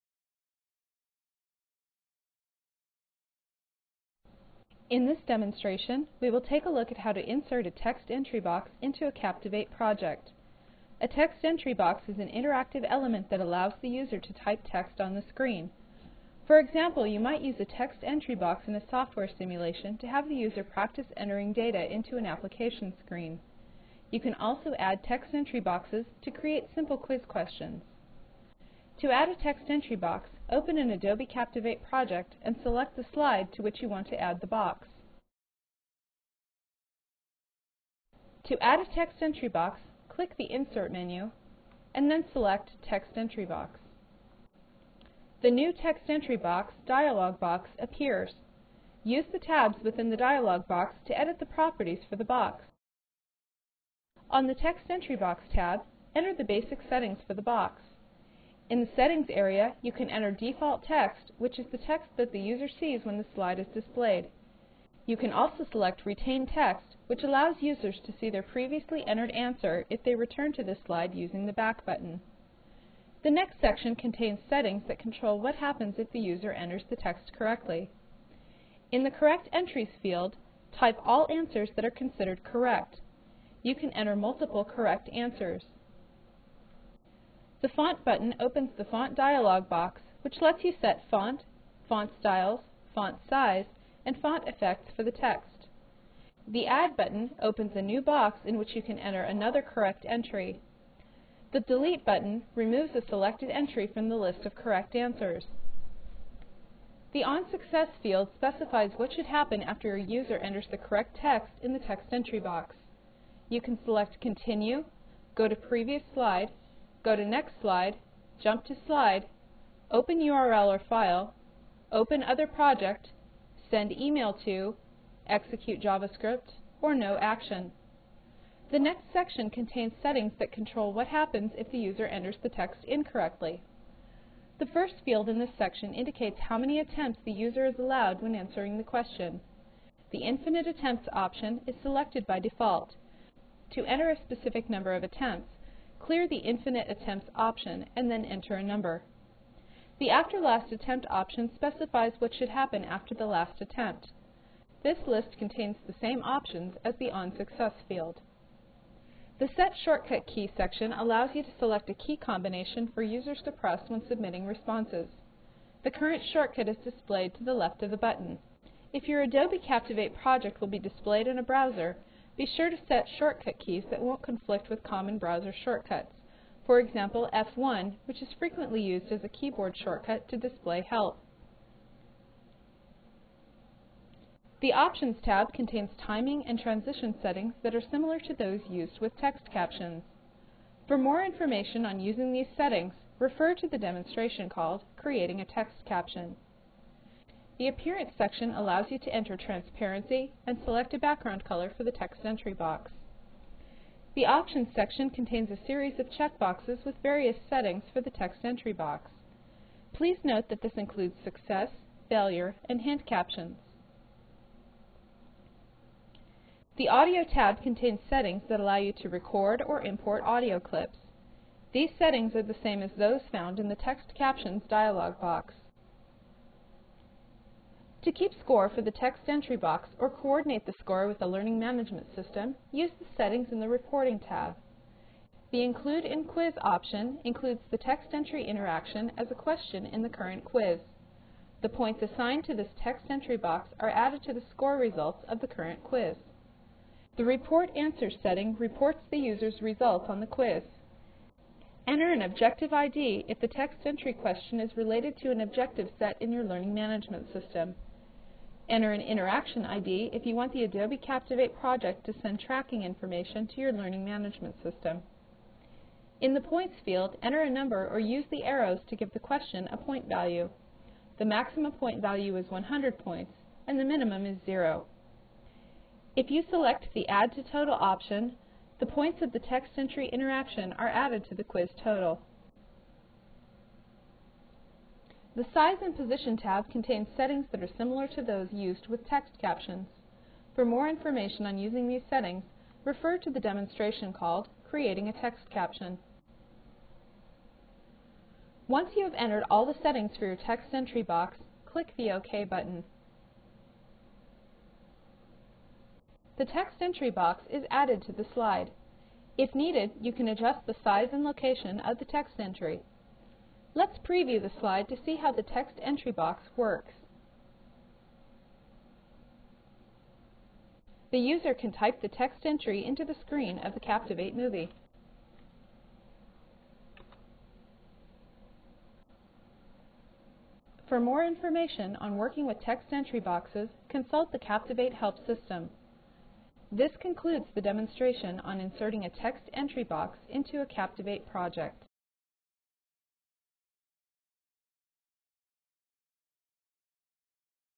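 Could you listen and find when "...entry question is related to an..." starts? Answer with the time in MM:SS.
04:13.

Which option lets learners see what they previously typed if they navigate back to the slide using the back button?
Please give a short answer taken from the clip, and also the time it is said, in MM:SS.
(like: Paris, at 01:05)
Retain Text, at 01:06.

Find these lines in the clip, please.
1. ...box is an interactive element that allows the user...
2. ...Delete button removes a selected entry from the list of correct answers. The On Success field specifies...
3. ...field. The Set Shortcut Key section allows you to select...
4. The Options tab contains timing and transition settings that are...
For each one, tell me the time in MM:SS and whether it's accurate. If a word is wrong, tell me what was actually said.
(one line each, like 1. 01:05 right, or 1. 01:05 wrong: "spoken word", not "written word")
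1. 00:11 right
2. 01:41 right
3. 02:37 right
4. 03:04 right.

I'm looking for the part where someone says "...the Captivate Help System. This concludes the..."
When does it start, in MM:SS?
05:34.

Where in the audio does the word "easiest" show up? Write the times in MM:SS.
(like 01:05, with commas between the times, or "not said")
not said.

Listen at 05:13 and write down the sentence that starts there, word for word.
Let's preview the slide to see how the text entry box works.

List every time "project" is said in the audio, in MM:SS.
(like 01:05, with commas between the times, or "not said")
00:09, 00:31, 02:02, 02:50, 04:21, 05:41.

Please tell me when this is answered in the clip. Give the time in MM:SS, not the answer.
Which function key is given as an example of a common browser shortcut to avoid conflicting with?
02:57.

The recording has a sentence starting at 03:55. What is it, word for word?
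The Include in Quiz option includes the text entry interaction as a question in the current quiz.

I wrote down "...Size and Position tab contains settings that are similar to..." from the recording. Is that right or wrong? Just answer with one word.
right.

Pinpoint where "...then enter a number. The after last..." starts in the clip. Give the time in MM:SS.
02:28.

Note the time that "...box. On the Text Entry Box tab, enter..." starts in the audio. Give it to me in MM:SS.
00:52.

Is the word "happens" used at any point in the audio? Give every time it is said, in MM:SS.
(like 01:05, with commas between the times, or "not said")
01:15, 01:49, 02:11, 02:32.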